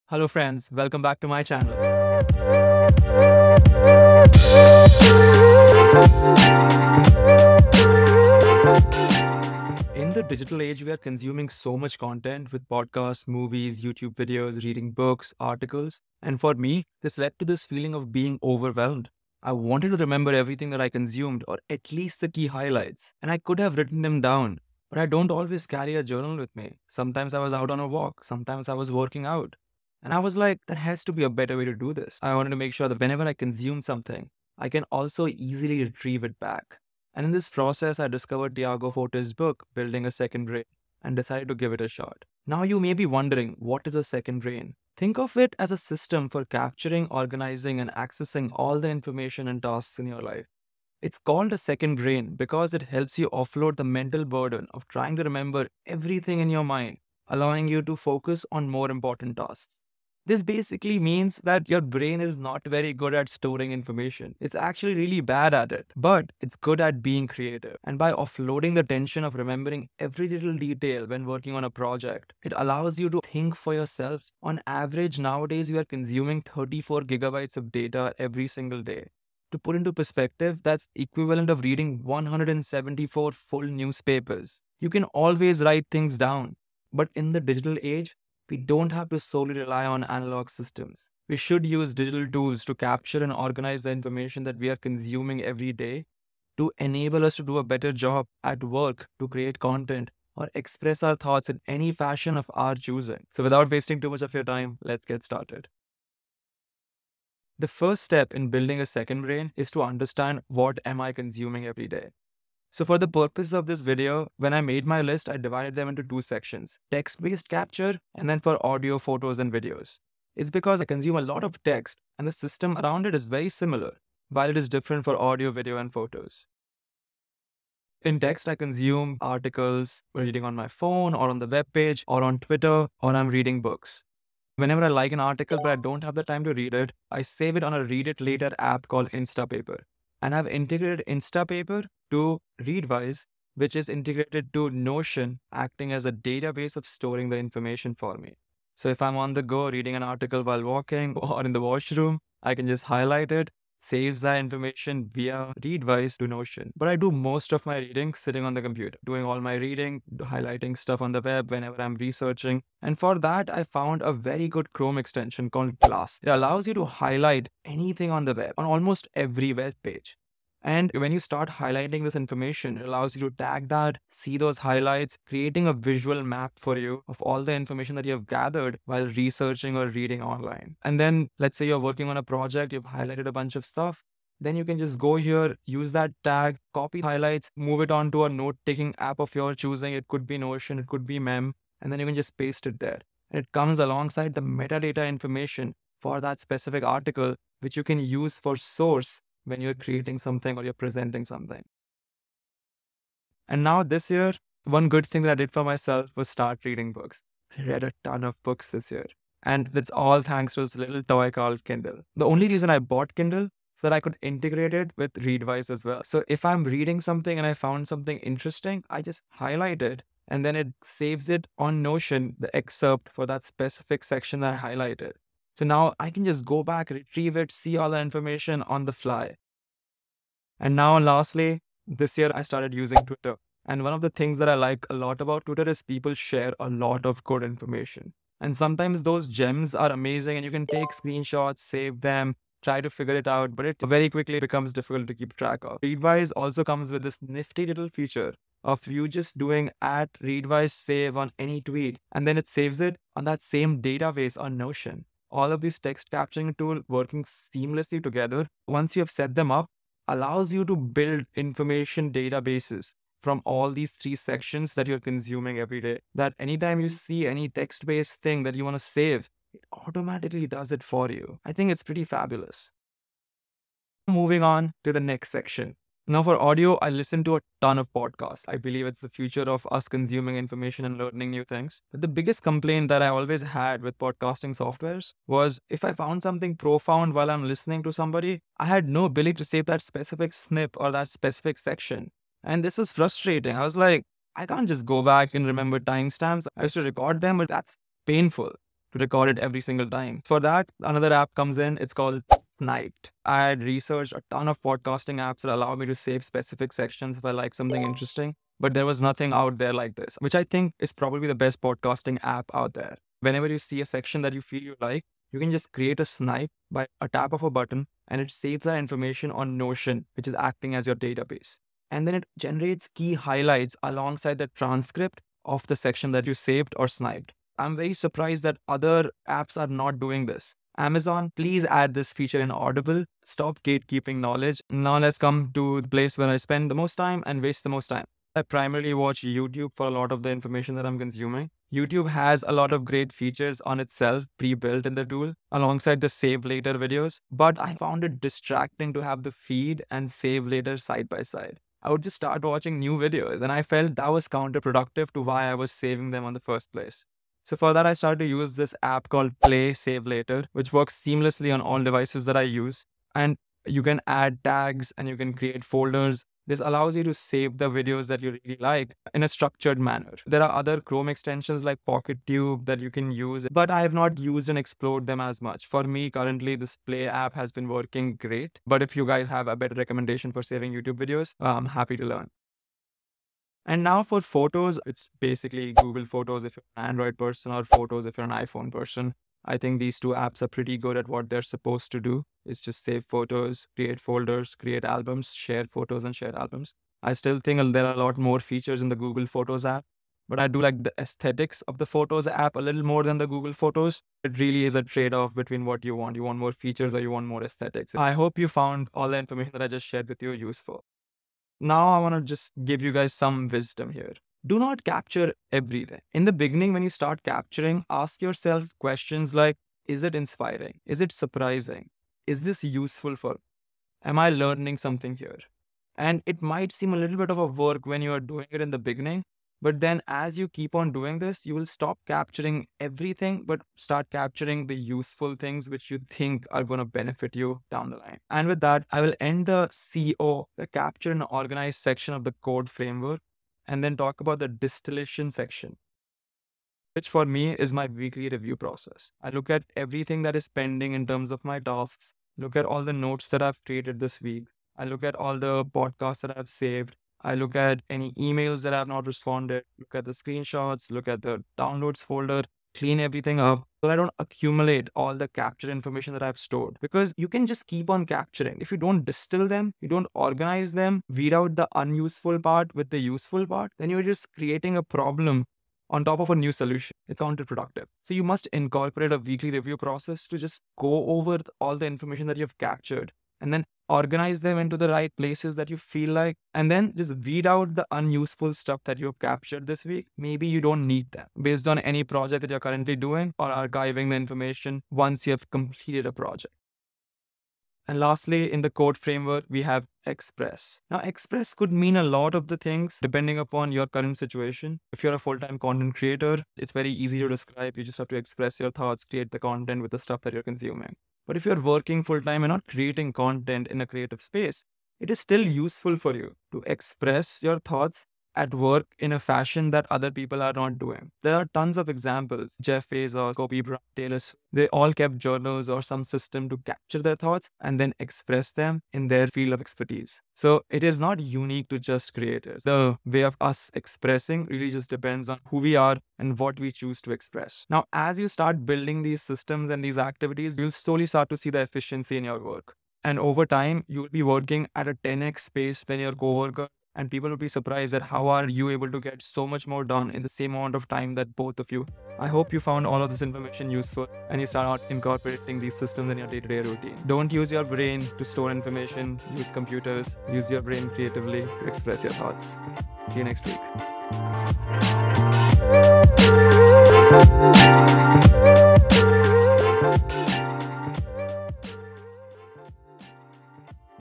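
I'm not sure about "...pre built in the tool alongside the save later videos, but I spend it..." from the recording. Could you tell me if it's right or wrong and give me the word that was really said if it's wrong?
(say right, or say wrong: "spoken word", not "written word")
wrong: "found", not "spend".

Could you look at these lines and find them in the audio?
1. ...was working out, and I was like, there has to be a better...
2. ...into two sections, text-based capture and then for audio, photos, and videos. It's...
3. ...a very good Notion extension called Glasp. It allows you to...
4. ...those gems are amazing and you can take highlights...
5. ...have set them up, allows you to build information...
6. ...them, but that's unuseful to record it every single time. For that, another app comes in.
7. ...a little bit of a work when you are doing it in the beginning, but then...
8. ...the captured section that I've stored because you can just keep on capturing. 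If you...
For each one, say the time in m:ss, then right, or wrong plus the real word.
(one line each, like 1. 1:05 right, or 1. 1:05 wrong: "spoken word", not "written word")
1. 0:28 right
2. 1:55 right
3. 2:44 wrong: "Chrome", not "Notion"
4. 3:59 wrong: "screenshots", not "highlights"
5. 4:19 right
6. 4:57 wrong: "painful", not "unuseful"
7. 7:06 right
8. 7:45 wrong: "information", not "section".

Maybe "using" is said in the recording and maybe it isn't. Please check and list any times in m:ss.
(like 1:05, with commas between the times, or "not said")
3:52.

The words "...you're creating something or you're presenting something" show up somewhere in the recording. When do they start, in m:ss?
3:19.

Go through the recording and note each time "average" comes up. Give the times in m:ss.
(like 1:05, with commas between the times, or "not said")
1:14.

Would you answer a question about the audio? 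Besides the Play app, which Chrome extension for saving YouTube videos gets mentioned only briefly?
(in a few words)
Pocket Tube.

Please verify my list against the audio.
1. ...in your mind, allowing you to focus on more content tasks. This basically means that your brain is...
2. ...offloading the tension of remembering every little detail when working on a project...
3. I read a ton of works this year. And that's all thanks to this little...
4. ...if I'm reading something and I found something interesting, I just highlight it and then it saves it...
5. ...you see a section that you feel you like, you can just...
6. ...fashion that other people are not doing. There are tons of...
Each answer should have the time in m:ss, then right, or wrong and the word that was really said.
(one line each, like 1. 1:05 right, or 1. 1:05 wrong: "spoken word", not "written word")
1. 0:56 wrong: "important", not "content"
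2. 1:08 right
3. 3:27 wrong: "books", not "works"
4. 3:36 right
5. 5:13 right
6. 8:39 right.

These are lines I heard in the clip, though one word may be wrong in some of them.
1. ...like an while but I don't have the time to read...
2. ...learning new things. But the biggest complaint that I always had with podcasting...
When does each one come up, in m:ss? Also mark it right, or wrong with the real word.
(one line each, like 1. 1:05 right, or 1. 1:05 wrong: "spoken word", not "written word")
1. 2:14 wrong: "article", not "while"
2. 4:40 right.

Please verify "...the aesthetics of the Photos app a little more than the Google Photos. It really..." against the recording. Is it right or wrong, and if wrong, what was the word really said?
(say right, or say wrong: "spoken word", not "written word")
right.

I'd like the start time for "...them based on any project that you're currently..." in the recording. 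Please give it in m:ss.
8:11.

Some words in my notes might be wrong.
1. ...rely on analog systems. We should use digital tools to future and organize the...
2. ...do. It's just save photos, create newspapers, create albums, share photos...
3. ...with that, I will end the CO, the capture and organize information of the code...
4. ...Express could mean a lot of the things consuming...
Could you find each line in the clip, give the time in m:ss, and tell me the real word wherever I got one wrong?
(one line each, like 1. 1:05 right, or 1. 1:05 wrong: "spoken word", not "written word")
1. 1:29 wrong: "capture", not "future"
2. 6:31 wrong: "folders", not "newspapers"
3. 7:18 wrong: "section", not "information"
4. 8:20 wrong: "depending", not "consuming".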